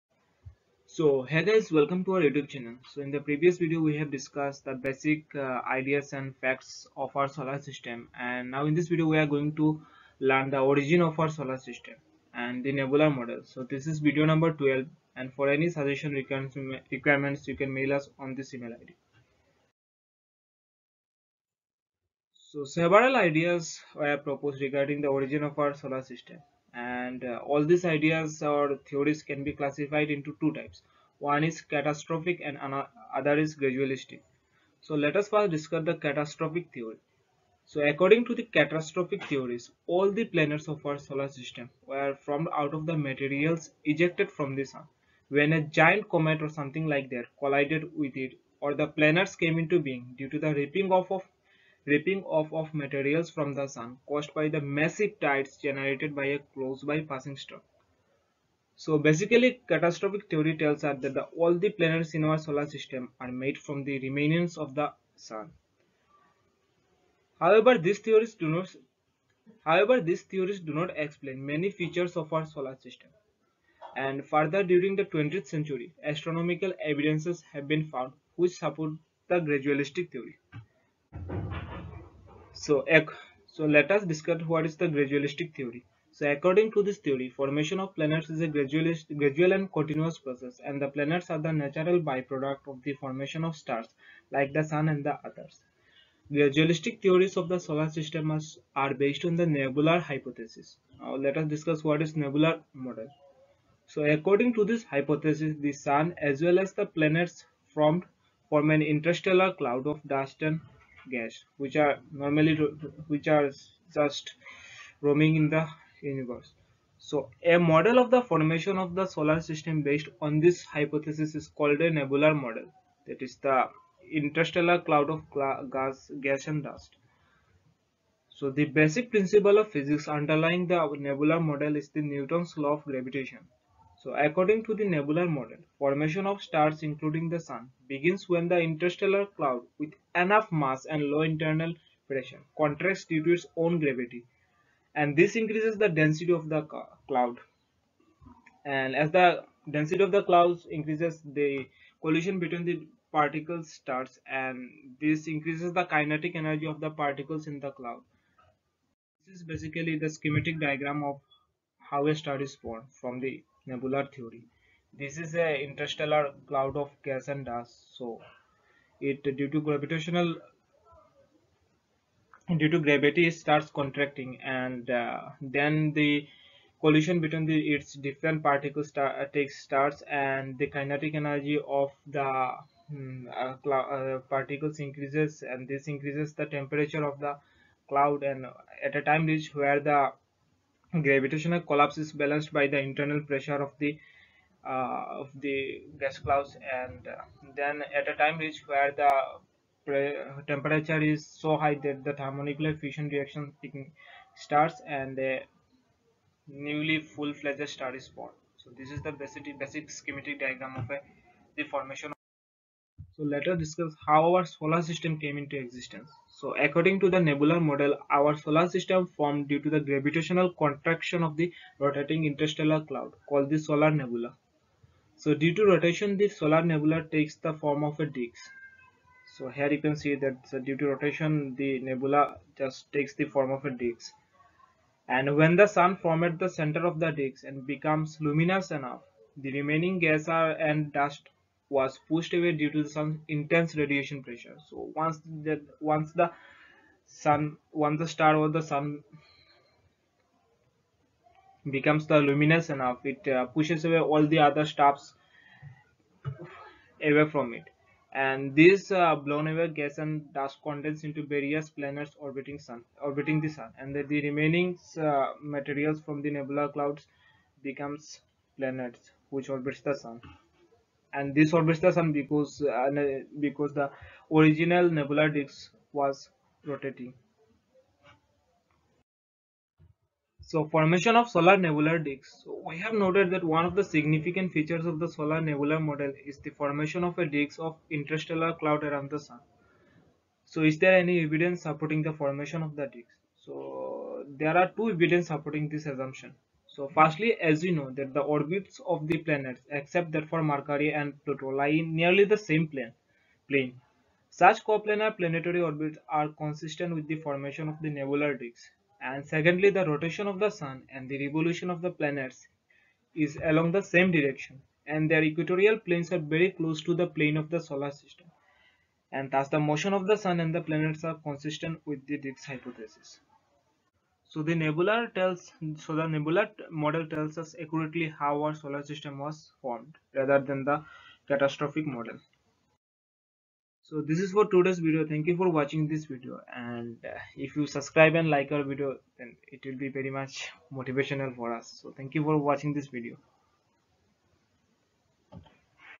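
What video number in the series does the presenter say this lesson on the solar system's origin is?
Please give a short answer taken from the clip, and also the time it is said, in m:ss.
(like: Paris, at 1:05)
12, at 0:13.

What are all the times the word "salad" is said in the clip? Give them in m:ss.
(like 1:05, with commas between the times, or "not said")
not said.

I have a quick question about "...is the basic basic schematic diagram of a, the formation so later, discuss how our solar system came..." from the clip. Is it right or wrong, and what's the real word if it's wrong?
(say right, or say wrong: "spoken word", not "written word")
right.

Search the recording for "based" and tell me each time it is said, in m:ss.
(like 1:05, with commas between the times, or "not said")
1:38, 1:59.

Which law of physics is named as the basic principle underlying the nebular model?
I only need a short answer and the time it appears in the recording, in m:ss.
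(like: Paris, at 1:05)
Newton's law of gravitation, at 2:12.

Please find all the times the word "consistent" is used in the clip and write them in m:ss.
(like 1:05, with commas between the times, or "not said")
5:06, 5:21.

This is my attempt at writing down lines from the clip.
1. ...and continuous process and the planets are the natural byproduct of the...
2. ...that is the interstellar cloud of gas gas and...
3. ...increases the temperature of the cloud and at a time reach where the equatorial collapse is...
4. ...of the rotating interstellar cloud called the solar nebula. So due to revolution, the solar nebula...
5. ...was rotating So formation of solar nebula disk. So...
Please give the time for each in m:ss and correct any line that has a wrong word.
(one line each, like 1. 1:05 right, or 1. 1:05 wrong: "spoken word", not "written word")
1. 1:29 right
2. 2:03 right
3. 3:05 wrong: "gravitational", not "equatorial"
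4. 3:41 wrong: "rotation", not "revolution"
5. 4:35 right.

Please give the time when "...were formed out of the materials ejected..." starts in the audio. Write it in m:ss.
0:41.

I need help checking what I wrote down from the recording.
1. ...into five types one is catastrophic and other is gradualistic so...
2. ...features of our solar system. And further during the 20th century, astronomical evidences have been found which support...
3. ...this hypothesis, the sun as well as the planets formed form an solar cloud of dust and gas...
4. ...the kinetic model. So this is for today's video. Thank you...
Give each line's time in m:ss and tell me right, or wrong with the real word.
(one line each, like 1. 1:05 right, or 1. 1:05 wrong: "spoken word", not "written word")
1. 0:30 wrong: "two", not "five"
2. 1:11 right
3. 1:44 wrong: "interstellar", not "solar"
4. 5:30 wrong: "catastrophic", not "kinetic".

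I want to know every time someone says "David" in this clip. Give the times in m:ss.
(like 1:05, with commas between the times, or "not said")
not said.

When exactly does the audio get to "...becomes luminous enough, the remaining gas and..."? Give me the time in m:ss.
3:57.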